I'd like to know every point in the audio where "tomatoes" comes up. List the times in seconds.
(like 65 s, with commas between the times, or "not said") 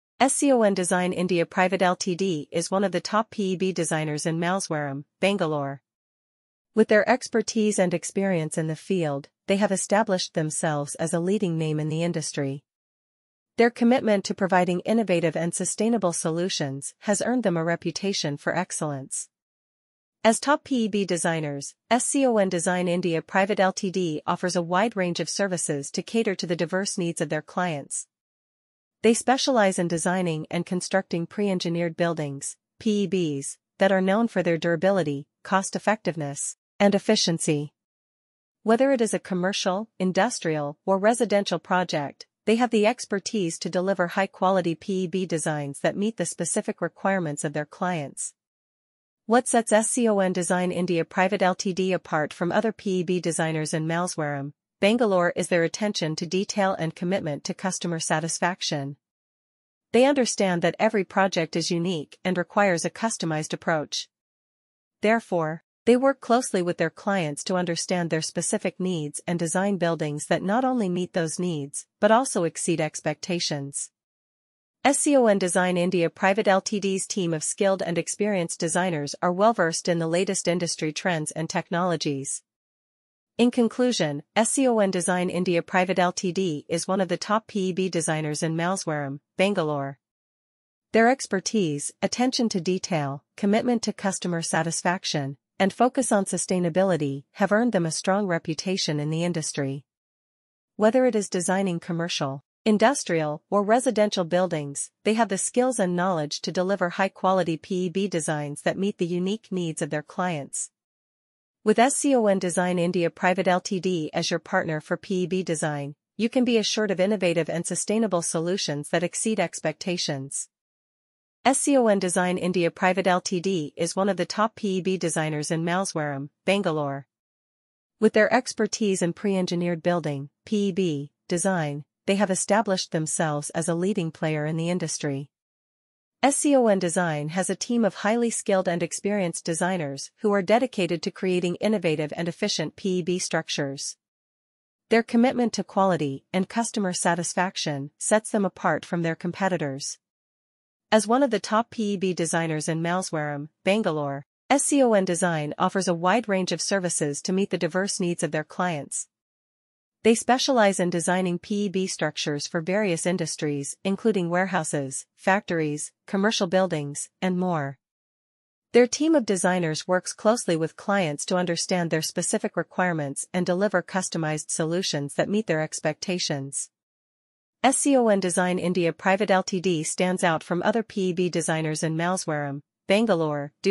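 not said.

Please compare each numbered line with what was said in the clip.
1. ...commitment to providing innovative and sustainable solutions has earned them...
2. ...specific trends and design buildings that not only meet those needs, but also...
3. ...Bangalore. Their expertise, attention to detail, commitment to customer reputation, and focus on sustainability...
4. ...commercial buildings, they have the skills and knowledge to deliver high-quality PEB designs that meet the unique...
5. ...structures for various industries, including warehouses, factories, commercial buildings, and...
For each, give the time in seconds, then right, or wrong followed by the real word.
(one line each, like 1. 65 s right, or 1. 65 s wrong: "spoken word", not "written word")
1. 13 s right
2. 68 s wrong: "needs", not "trends"
3. 89 s wrong: "satisfaction", not "reputation"
4. 103 s wrong: "residential", not "commercial"
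5. 161 s right.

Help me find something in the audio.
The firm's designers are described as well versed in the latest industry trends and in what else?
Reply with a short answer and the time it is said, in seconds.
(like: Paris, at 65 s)
technologies, at 81 s.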